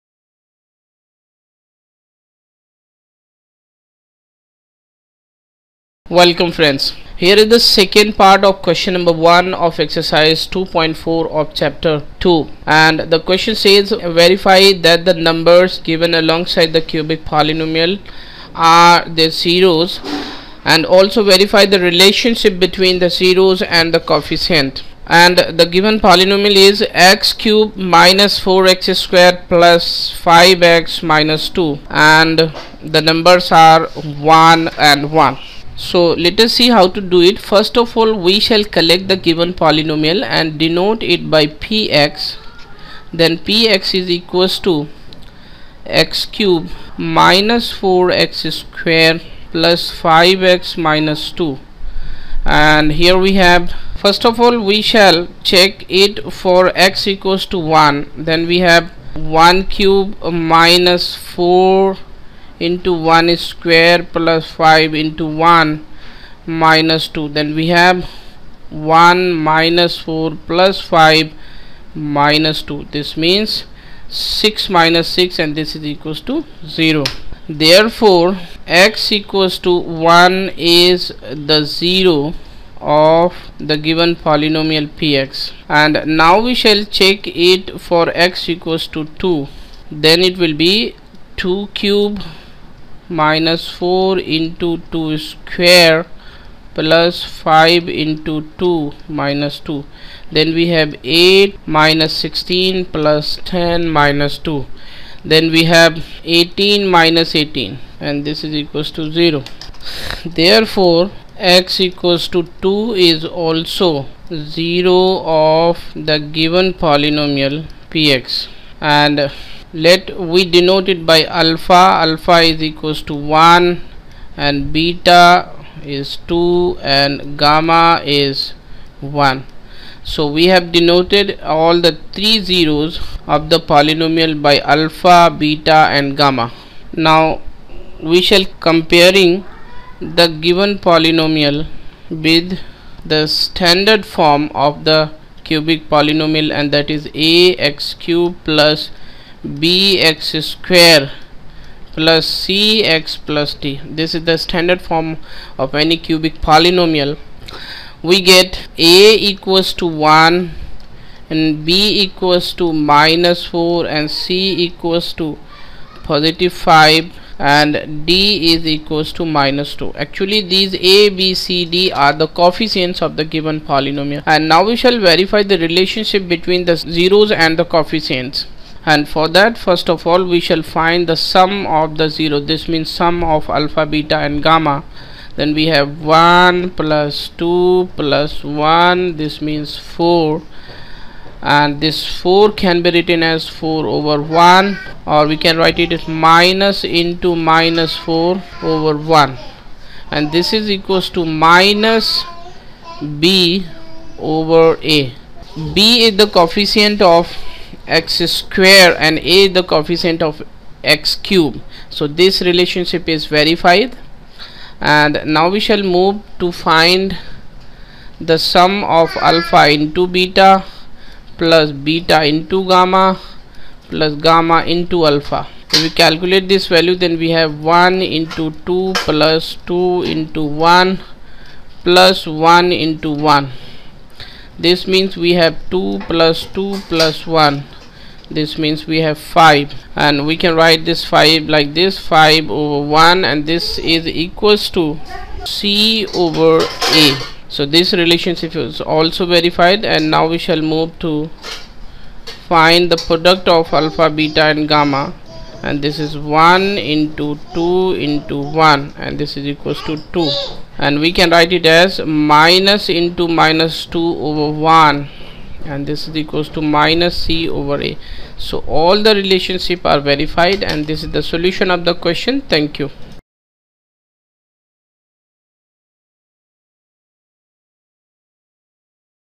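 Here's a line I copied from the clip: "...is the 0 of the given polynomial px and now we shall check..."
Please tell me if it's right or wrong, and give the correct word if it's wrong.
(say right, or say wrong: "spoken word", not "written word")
right.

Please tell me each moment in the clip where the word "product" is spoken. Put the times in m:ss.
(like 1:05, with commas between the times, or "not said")
4:13.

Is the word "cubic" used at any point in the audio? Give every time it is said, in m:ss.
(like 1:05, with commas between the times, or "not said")
0:16, 2:25, 2:35.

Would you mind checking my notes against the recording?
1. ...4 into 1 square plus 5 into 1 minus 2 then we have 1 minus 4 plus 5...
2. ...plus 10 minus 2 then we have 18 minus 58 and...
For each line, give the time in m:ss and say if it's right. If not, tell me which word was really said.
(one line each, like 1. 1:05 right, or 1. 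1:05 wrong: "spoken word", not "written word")
1. 1:01 right
2. 1:42 wrong: "18", not "58".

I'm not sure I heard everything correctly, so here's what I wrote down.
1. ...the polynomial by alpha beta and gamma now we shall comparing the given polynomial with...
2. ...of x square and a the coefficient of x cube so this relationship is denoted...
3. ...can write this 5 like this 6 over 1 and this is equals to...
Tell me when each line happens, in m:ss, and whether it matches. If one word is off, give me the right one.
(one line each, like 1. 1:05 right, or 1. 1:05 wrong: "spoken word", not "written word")
1. 2:13 right
2. 3:27 wrong: "verified", not "denoted"
3. 4:00 wrong: "5", not "6".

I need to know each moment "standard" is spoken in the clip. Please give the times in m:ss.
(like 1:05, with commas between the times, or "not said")
2:23, 2:34.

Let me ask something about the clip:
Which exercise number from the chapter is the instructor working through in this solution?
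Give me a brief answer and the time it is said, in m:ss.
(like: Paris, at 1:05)
2.4, at 0:10.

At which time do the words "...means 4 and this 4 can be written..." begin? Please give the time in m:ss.
3:09.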